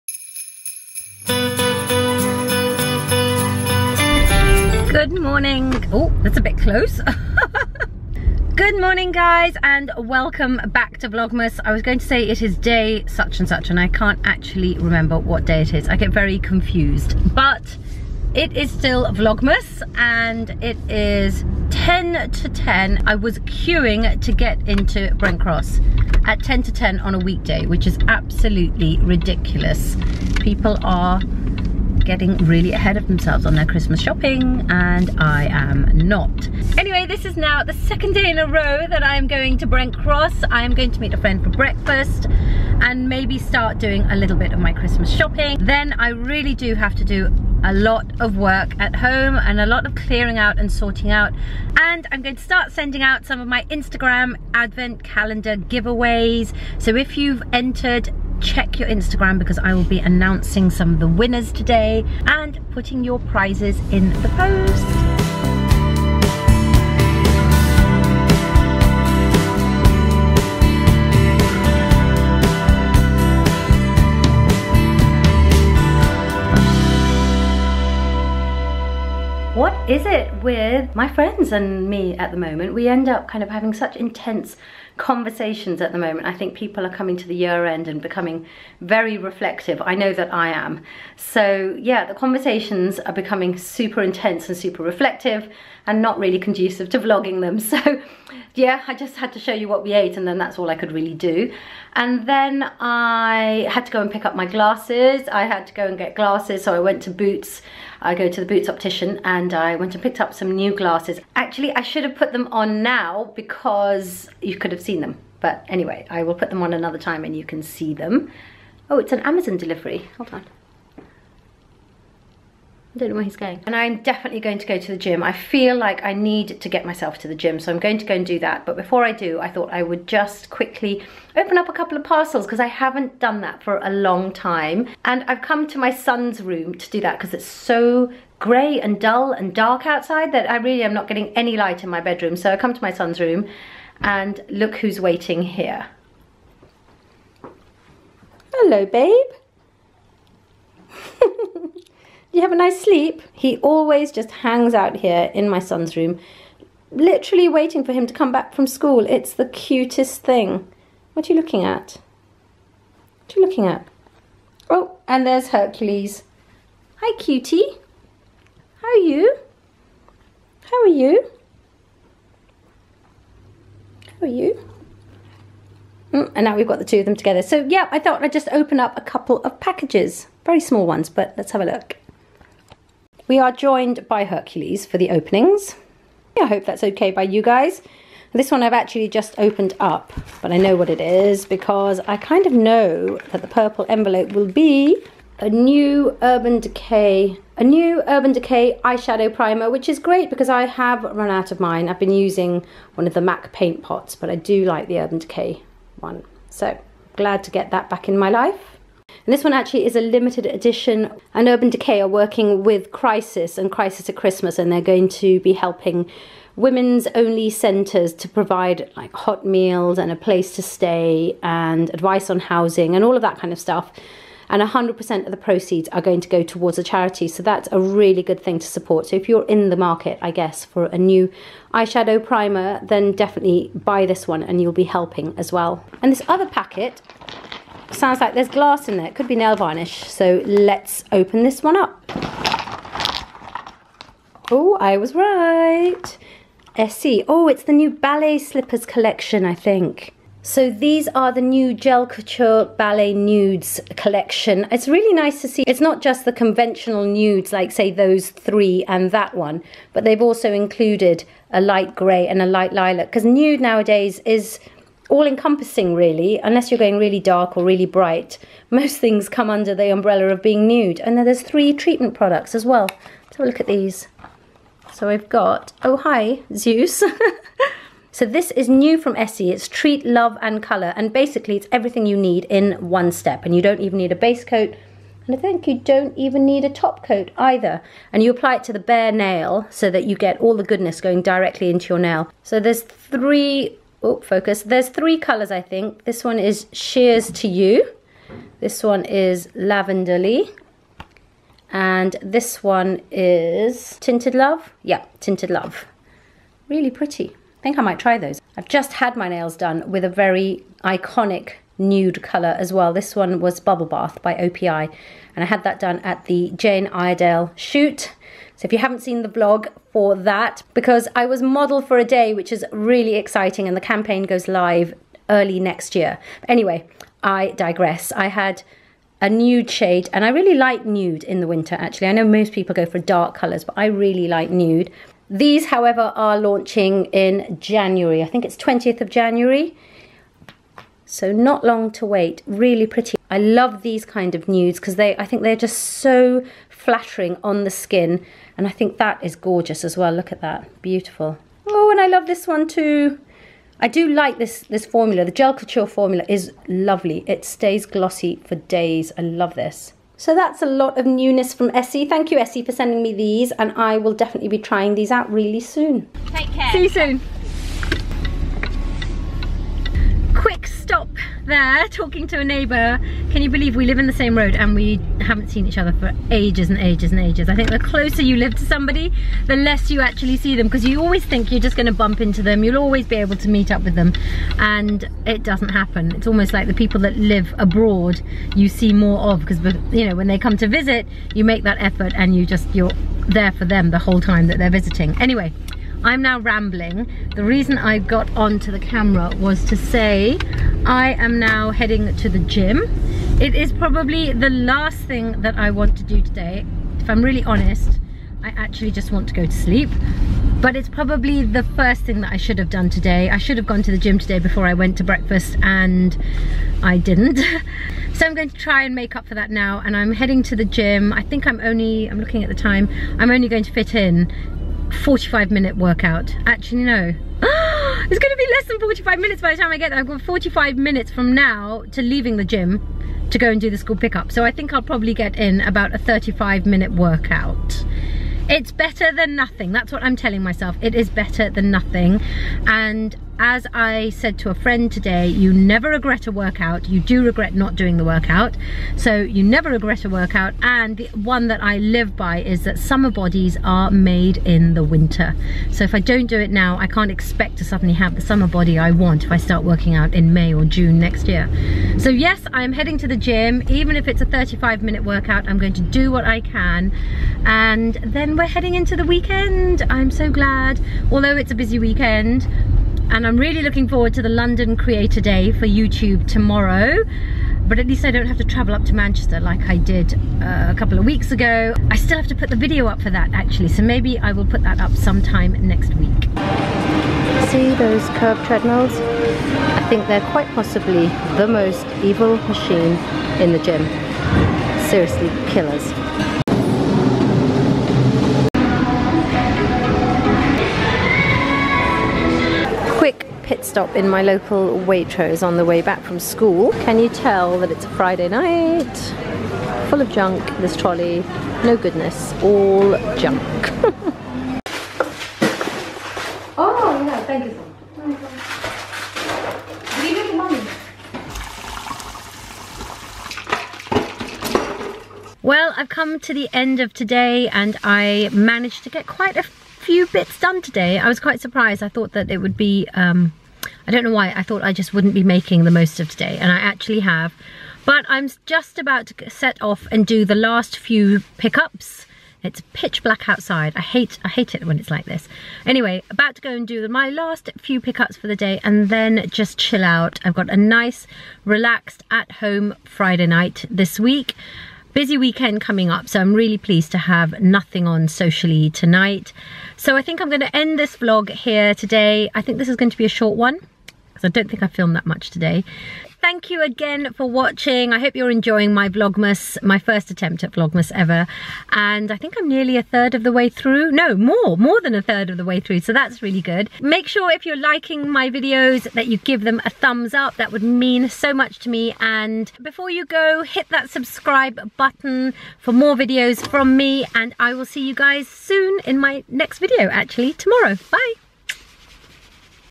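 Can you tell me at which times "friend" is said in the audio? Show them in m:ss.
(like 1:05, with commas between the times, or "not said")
0:41, 1:21, 7:24.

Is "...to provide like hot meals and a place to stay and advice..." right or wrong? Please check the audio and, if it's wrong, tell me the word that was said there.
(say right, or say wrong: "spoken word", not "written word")
right.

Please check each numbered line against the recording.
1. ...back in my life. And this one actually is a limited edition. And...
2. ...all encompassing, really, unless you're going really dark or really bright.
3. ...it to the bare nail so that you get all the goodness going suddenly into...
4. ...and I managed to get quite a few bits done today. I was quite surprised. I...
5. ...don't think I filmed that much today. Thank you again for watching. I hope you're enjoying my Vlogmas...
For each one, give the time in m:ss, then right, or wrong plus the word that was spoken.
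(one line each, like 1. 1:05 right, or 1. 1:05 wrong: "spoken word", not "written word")
1. 3:27 right
2. 4:25 right
3. 4:48 wrong: "directly", not "suddenly"
4. 8:47 right
5. 9:24 right.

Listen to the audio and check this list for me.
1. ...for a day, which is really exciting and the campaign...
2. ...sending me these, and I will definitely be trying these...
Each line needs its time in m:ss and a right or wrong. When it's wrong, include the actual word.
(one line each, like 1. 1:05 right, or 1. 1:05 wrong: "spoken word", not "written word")
1. 5:21 right
2. 6:02 right.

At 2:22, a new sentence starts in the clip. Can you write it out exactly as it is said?
So I come to my son's room and look who's waiting here.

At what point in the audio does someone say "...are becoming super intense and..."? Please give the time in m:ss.
1:32.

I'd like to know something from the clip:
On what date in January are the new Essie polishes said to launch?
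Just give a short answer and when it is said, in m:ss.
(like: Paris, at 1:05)
20th of January, at 5:38.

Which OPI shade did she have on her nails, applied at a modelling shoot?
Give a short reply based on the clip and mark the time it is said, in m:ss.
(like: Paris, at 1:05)
Bubble Bath, at 5:13.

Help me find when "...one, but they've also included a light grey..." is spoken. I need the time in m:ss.
4:19.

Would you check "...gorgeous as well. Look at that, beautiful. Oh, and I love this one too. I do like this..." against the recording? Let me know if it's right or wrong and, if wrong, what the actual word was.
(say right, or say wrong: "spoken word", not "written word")
right.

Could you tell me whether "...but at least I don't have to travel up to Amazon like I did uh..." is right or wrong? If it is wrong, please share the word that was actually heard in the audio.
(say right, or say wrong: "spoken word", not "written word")
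wrong: "Manchester", not "Amazon".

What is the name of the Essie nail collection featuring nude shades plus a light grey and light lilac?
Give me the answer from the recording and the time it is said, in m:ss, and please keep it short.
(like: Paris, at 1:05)
Gel Couture Ballet Nudes, at 4:11.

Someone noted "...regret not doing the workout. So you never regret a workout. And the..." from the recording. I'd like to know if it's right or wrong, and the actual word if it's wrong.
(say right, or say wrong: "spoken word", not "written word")
right.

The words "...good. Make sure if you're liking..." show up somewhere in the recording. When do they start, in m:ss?
9:36.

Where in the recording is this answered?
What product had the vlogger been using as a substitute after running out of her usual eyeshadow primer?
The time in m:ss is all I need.
3:23.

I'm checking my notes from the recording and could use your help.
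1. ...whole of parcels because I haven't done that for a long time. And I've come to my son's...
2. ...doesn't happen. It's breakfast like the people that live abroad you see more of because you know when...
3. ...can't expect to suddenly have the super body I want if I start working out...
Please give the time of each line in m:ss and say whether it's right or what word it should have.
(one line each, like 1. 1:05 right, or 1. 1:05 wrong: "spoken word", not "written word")
1. 2:11 wrong: "couple", not "whole"
2. 6:25 wrong: "almost", not "breakfast"
3. 7:36 wrong: "summer", not "super".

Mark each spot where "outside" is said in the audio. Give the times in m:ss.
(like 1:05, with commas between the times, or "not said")
2:19, 9:03.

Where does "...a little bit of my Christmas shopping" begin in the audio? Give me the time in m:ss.
0:44.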